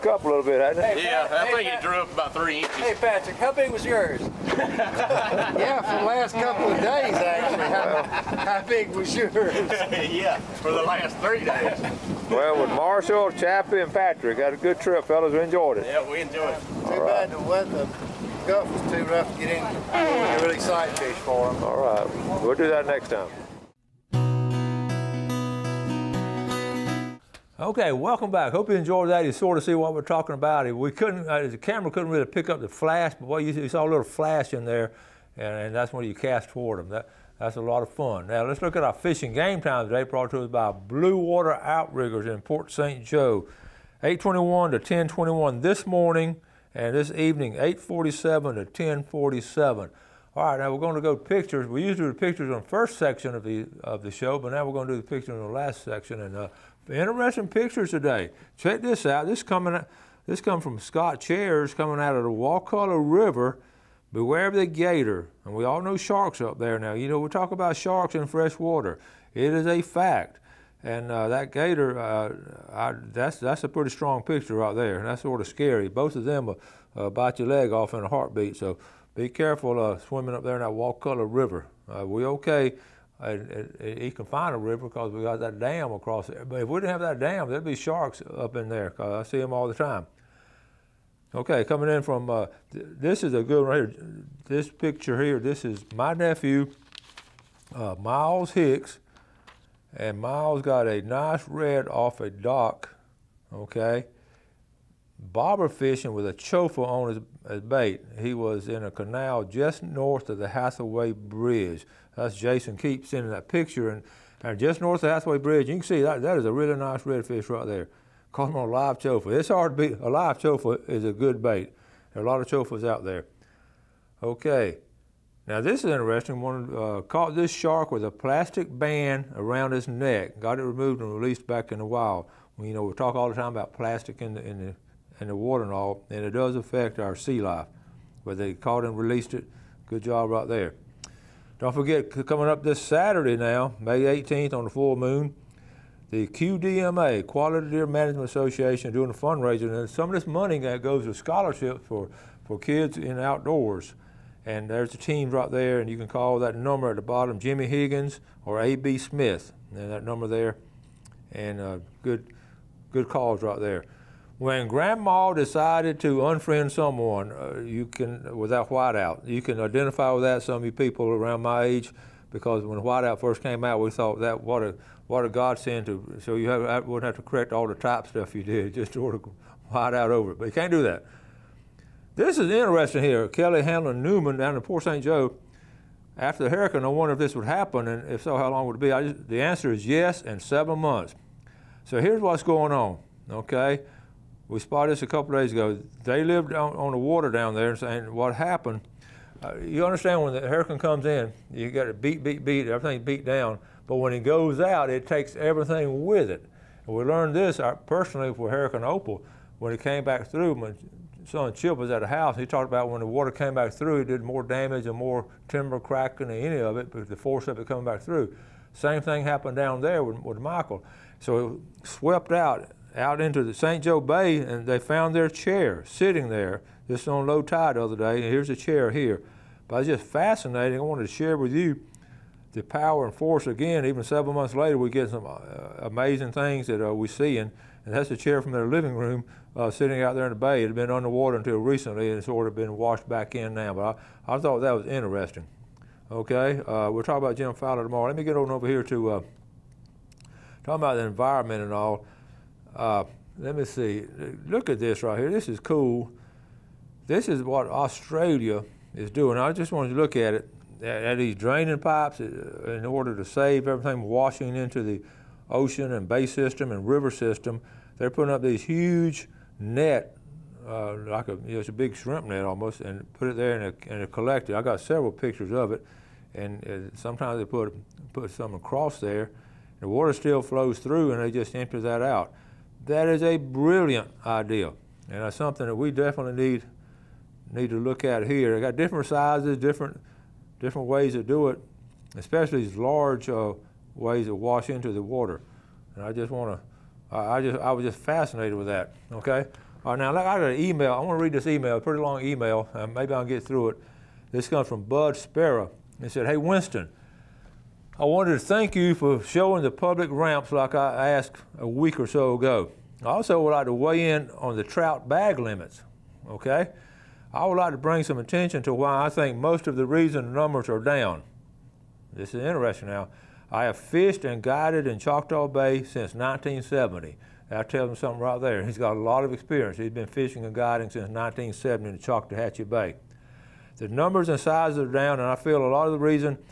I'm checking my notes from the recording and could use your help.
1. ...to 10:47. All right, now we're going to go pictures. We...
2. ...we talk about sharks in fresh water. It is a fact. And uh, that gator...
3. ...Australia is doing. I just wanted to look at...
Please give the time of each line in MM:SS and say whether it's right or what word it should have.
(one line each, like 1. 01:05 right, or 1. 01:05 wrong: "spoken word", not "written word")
1. 00:48 right
2. 01:07 right
3. 04:17 right.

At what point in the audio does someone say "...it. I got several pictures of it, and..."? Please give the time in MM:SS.
04:34.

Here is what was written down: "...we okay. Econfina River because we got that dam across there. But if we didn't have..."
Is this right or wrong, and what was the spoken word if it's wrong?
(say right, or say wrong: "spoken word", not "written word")
right.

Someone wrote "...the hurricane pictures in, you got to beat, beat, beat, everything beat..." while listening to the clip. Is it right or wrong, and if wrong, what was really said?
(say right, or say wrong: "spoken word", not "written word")
wrong: "comes", not "pictures".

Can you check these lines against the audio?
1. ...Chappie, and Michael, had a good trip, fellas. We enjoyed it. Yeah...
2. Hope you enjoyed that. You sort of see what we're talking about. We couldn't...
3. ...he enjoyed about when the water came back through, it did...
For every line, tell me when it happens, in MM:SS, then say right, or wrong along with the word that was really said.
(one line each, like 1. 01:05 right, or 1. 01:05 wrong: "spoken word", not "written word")
1. 00:13 wrong: "Patrick", not "Michael"
2. 00:28 right
3. 03:32 wrong: "talked", not "enjoyed".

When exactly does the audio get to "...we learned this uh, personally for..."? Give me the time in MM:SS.
03:26.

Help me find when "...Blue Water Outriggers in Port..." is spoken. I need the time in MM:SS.
00:40.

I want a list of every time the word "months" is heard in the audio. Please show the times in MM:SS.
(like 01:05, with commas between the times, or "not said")
03:10, 03:54.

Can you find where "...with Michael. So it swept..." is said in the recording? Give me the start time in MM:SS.
03:40.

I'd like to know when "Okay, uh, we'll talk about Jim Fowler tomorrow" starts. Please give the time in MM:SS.
04:06.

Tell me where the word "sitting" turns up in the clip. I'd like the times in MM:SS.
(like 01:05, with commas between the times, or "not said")
03:45, 03:59.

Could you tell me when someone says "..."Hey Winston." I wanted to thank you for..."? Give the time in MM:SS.
05:06.